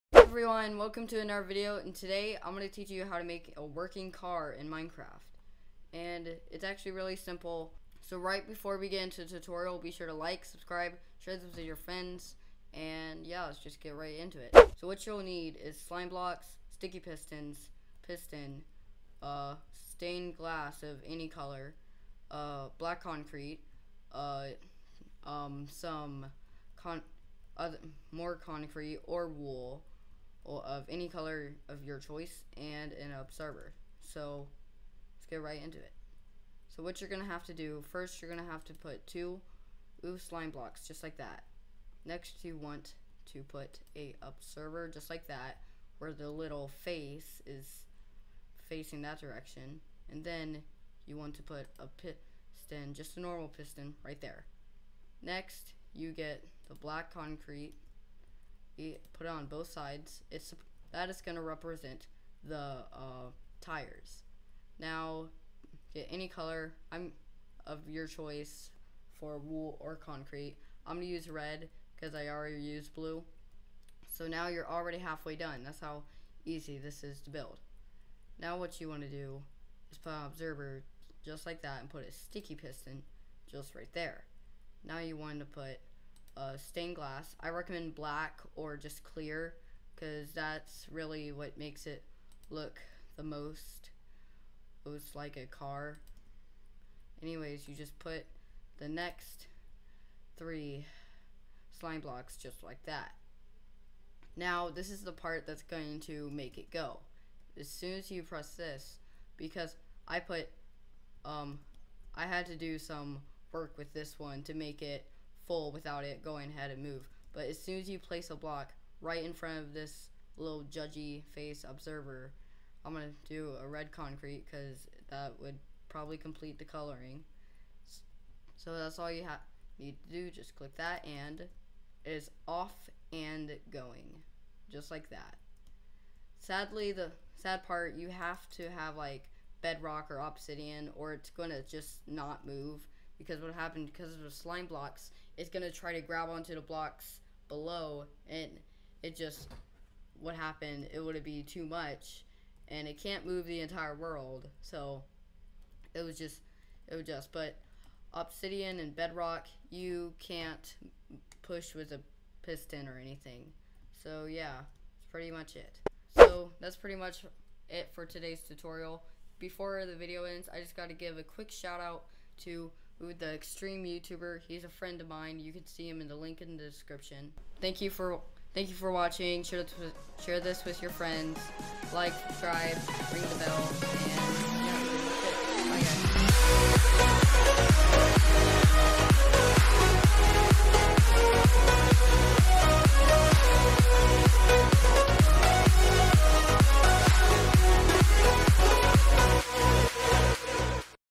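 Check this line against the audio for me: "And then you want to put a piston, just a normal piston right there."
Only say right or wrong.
right.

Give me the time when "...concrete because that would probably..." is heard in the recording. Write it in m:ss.
2:03.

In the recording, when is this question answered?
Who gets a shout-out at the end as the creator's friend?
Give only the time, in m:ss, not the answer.
2:53.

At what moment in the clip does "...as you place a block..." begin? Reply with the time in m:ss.
1:57.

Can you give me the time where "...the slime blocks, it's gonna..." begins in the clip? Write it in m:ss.
2:24.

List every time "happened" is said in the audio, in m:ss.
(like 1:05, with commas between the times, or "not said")
2:23, 2:30.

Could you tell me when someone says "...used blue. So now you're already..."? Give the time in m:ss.
1:12.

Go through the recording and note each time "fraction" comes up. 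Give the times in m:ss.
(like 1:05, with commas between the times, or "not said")
not said.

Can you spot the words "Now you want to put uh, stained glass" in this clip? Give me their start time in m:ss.
1:24.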